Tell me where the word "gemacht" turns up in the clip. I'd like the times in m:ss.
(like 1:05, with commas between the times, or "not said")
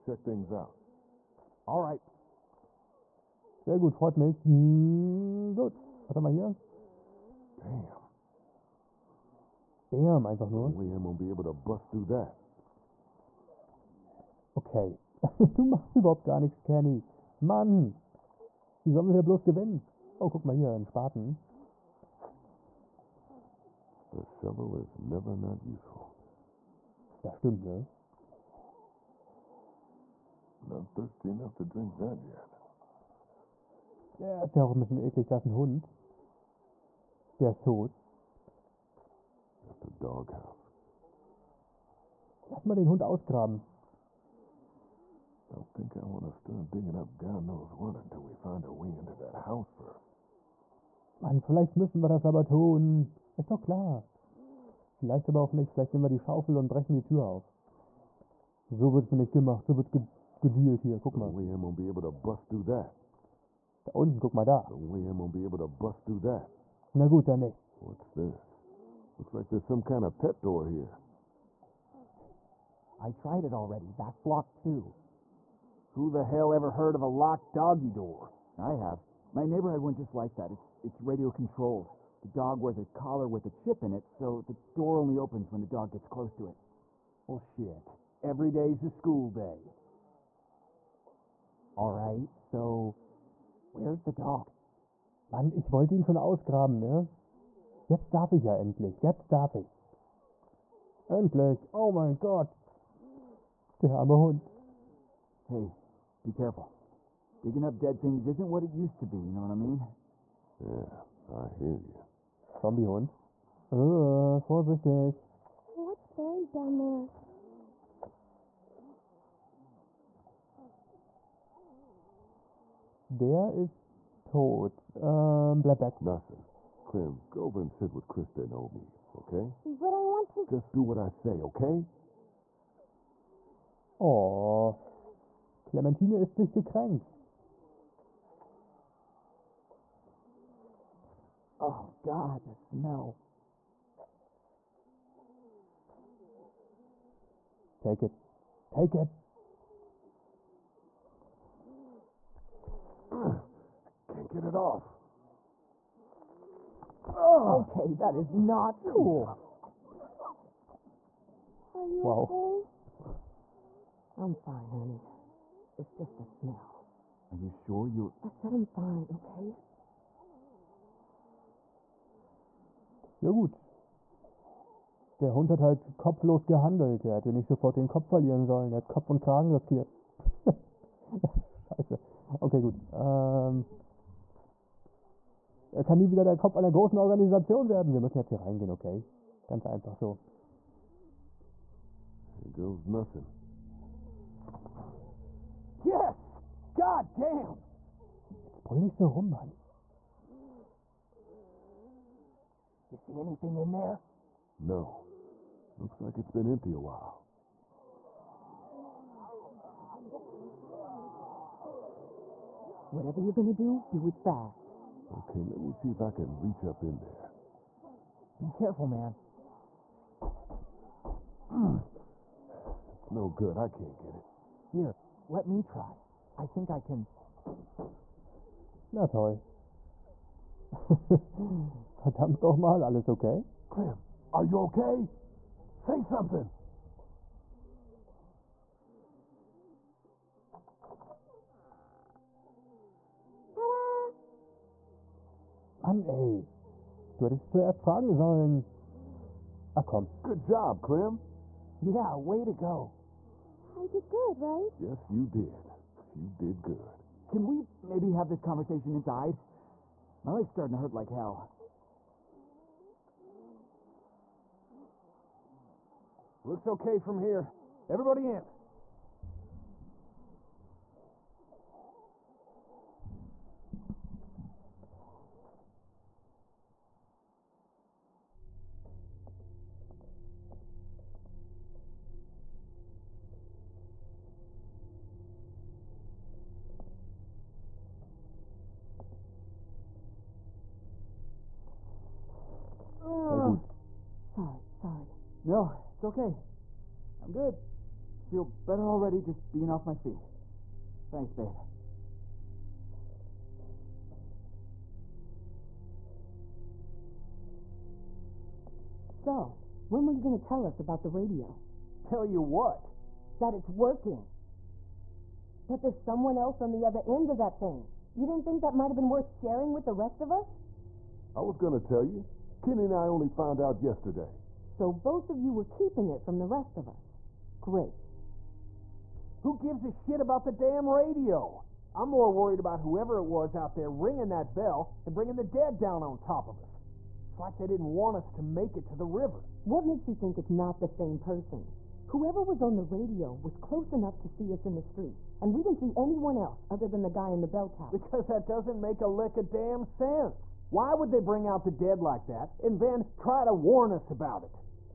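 0:59.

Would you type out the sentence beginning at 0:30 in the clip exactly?
Not thirsty enough to drink that yet.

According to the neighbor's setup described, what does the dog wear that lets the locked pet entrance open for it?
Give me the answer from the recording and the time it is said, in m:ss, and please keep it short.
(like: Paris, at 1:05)
a collar with a chip, at 1:22.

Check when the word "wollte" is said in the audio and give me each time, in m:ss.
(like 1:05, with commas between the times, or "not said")
1:35.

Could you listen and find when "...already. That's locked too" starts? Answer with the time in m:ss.
1:13.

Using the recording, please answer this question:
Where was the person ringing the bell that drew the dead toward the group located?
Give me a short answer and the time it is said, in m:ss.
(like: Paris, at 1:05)
the bell tower, at 5:47.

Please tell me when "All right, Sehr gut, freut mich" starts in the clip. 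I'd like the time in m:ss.
0:01.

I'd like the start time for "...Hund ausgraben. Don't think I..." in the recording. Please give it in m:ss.
0:42.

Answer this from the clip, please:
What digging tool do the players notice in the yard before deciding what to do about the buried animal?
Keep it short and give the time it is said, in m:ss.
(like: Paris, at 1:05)
Spaten, at 0:20.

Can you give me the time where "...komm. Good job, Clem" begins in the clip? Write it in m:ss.
4:09.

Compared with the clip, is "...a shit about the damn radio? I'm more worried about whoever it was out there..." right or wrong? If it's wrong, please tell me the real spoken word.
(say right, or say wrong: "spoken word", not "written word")
right.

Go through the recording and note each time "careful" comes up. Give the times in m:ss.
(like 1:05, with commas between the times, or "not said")
1:46, 3:38.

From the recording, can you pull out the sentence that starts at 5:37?
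It's like they didn't want us to make it to the river.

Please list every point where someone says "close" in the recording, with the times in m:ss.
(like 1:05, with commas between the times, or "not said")
1:26, 5:43.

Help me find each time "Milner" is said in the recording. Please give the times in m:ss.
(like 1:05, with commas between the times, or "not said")
not said.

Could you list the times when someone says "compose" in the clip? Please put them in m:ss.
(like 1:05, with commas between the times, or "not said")
not said.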